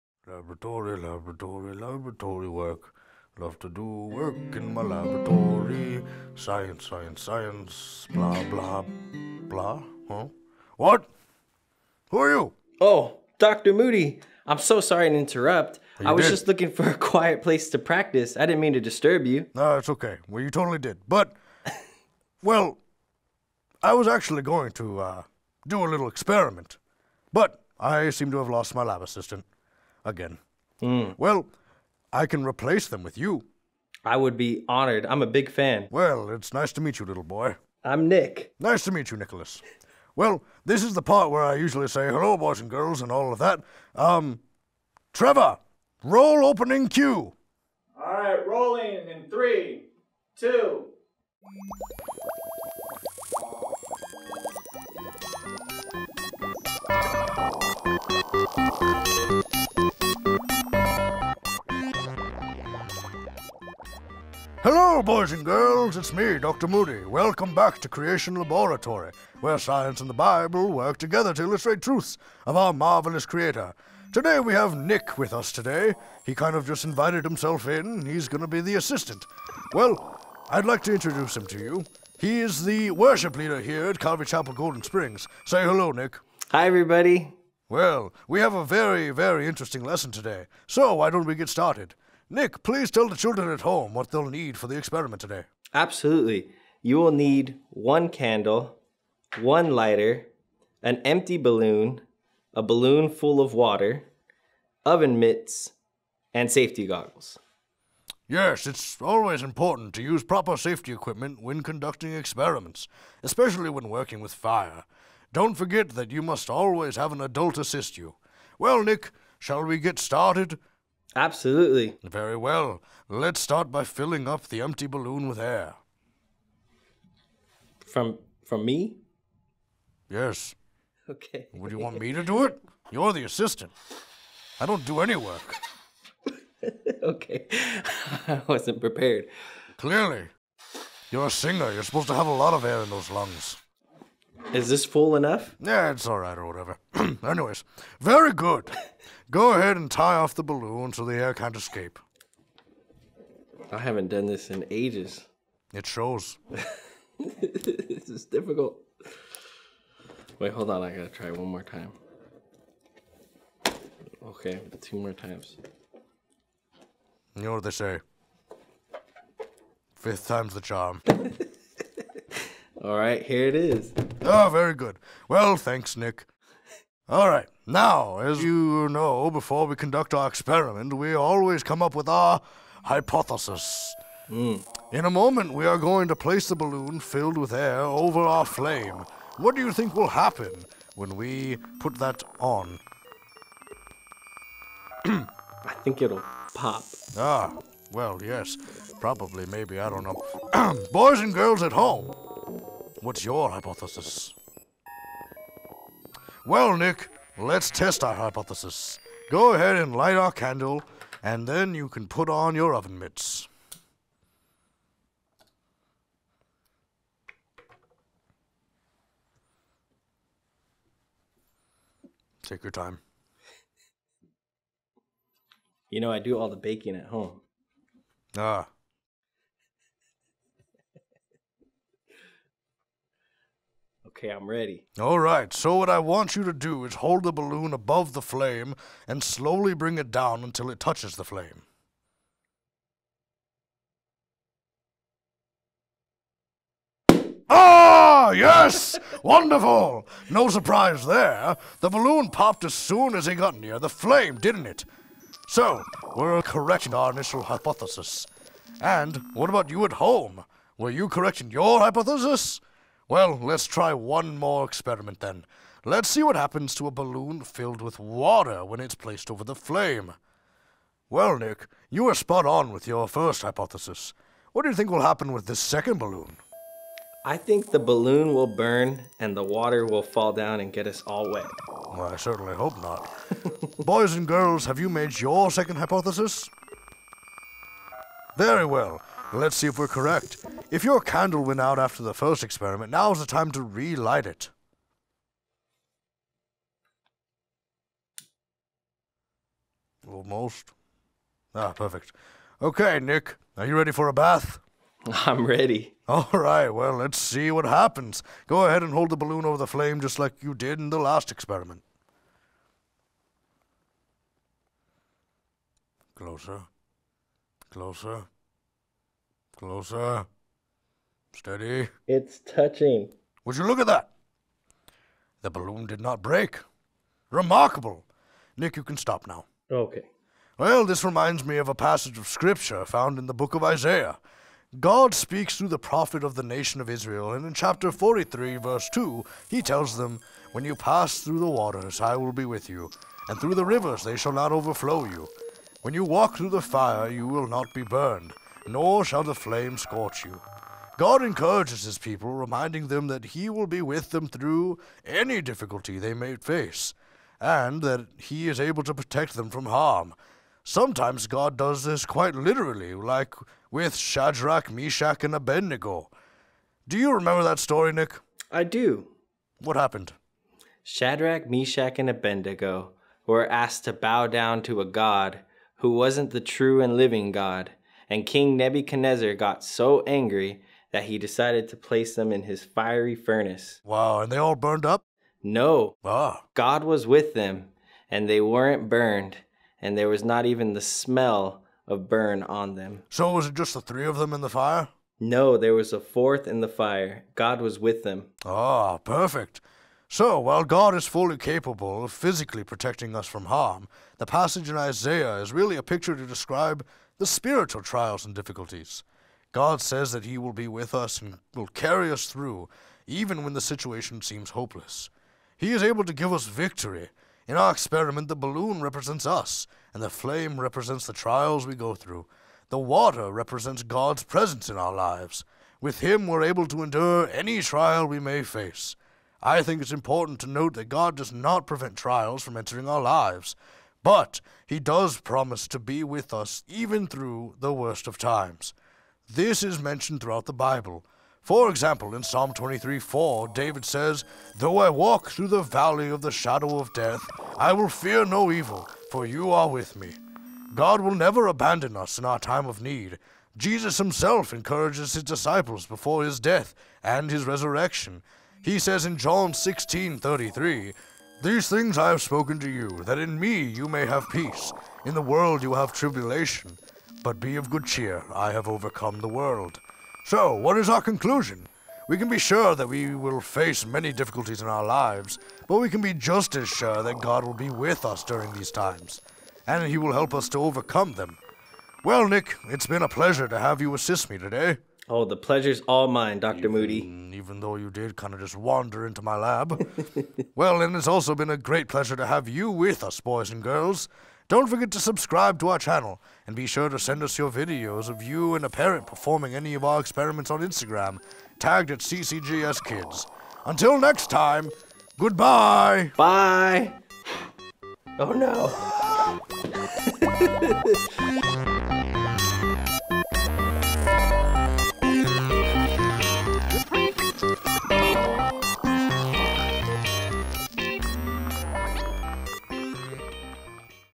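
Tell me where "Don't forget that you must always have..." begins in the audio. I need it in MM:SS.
01:55.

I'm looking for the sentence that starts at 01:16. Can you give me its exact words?
He kind of just invited himself in.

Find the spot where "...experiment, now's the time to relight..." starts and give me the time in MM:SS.
04:52.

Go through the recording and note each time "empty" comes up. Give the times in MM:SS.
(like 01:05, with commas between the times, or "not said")
01:41, 02:04.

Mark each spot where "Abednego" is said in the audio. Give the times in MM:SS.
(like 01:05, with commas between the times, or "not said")
06:05, 06:12.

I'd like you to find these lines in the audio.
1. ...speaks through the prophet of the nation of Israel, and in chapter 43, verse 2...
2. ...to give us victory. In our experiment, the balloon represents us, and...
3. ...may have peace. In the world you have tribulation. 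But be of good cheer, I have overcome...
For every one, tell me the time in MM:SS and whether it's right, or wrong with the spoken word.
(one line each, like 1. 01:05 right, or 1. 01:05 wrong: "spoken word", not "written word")
1. 05:35 right
2. 06:56 right
3. 07:43 right.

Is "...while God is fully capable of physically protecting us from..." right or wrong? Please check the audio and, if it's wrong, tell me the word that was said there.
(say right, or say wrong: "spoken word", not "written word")
right.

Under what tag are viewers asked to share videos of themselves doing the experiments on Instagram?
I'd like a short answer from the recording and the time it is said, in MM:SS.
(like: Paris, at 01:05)
CCGS Kids, at 08:21.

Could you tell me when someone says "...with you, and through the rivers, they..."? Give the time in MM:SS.
05:42.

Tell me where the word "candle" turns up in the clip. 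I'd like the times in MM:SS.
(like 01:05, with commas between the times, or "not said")
01:38, 03:30, 04:50.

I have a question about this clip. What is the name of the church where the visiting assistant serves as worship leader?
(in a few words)
Calvary Chapel Golden Springs.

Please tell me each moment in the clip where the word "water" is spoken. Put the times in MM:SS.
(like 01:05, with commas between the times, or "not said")
01:43, 04:27, 04:39, 05:41, 07:02.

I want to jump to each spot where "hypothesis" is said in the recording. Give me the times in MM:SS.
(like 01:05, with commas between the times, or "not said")
03:02, 03:23, 03:28, 04:17, 04:21, 04:33, 04:45.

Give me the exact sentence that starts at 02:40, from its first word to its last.
I gotta try one more time.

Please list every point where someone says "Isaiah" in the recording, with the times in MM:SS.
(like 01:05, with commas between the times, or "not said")
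05:33, 06:44.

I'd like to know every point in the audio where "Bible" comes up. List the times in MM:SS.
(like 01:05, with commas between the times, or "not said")
01:10, 07:20.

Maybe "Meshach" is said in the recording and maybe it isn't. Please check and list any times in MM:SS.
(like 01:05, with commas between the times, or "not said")
06:04, 06:11.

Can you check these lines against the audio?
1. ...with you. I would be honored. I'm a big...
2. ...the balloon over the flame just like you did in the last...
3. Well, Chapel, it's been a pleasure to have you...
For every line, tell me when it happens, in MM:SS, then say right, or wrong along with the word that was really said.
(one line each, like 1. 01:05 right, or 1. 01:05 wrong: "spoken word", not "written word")
1. 00:33 right
2. 05:09 right
3. 08:02 wrong: "Nick", not "Chapel".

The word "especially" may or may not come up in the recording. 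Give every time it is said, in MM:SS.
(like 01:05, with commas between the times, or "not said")
01:53.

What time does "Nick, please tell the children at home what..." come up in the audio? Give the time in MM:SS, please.
01:32.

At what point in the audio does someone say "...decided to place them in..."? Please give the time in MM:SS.
06:21.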